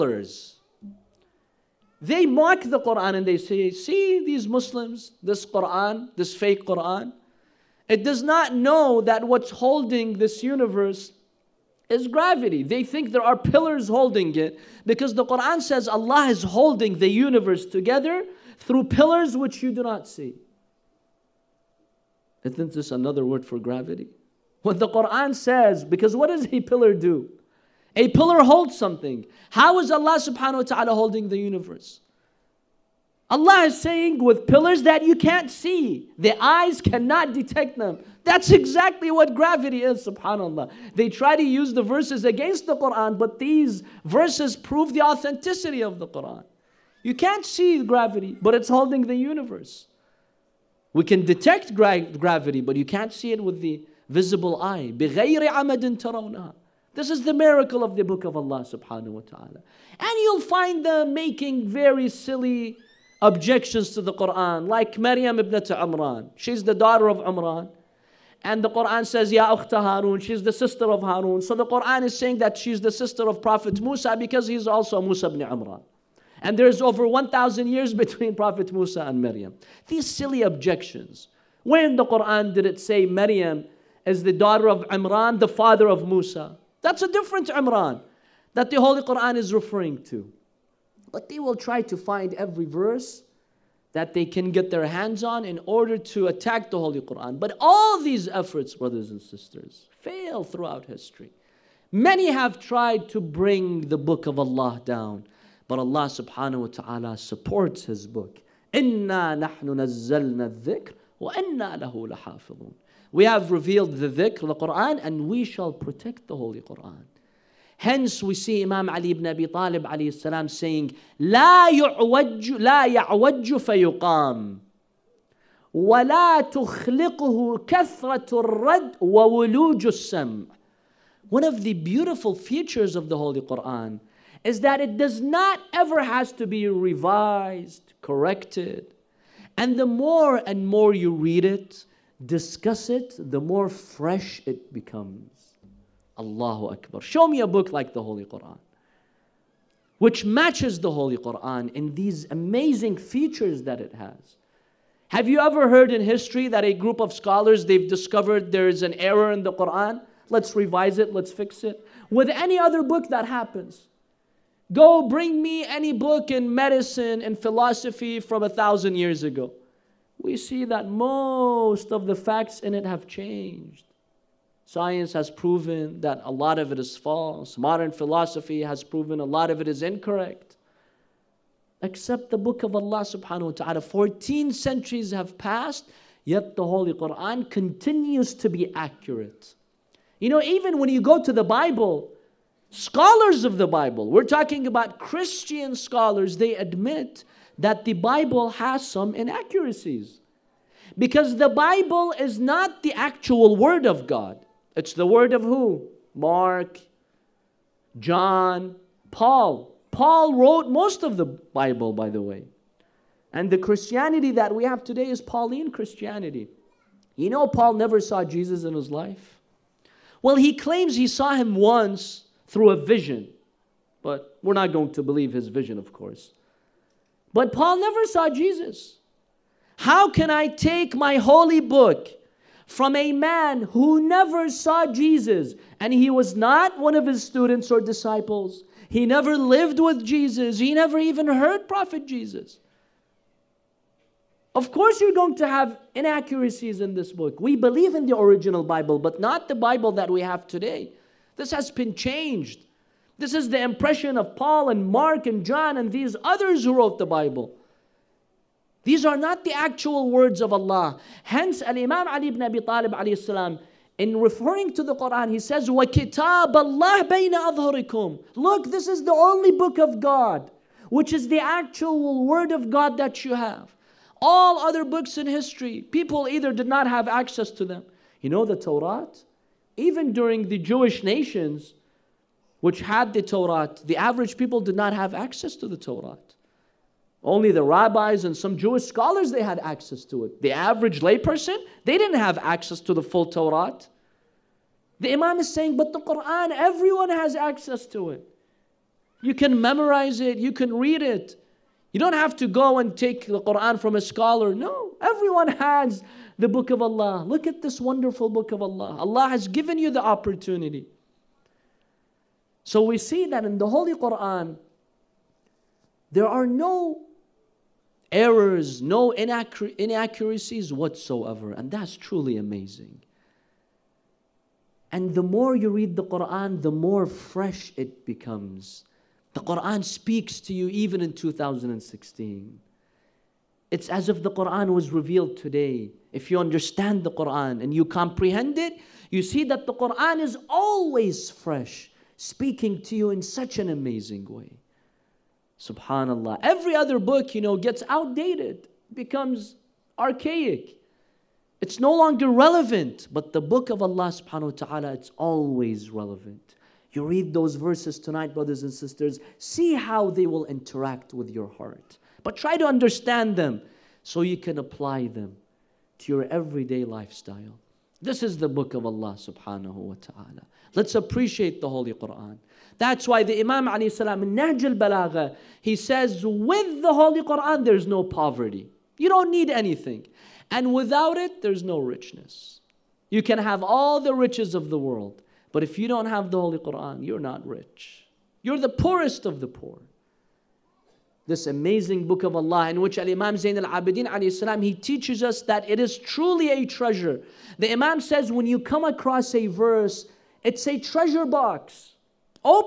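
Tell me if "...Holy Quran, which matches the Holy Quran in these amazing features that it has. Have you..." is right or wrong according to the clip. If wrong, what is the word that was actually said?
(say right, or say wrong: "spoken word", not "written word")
right.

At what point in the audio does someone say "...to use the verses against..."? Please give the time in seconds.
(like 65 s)
41 s.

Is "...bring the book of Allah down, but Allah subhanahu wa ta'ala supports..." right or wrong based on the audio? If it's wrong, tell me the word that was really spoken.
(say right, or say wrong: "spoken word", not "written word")
right.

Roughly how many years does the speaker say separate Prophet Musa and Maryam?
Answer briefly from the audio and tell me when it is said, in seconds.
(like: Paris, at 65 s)
Over 1,000 years, at 76 s.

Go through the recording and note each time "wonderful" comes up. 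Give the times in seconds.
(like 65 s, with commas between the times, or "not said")
307 s.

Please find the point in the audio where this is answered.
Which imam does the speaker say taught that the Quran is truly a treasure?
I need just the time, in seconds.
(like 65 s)
392 s.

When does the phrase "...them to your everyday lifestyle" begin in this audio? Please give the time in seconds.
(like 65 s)
365 s.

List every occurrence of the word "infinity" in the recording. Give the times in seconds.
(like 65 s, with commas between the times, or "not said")
not said.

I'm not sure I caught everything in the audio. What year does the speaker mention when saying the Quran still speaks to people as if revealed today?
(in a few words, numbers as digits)
2016.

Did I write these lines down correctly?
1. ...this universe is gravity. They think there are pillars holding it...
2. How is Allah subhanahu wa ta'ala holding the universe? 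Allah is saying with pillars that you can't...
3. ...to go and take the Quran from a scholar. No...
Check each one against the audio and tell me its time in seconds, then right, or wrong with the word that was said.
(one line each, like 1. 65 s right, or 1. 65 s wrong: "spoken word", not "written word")
1. 10 s right
2. 29 s right
3. 302 s right.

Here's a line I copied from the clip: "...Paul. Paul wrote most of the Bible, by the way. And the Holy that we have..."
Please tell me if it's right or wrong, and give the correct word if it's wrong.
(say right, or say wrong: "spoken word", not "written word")
wrong: "Christianity", not "Holy".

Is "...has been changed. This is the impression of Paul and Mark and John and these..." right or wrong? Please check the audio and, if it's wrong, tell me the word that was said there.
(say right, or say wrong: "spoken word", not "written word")
right.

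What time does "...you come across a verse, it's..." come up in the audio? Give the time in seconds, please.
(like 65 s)
398 s.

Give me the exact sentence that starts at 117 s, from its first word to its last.
Hence, we see Imam Ali ibn Abi Talib alayhi salam saying, لا يعوج, لا يعوج فيقام ولا تخلقه كثرة الرد وولوج السمع.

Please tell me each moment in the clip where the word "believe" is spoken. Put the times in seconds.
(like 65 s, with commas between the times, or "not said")
225 s, 247 s.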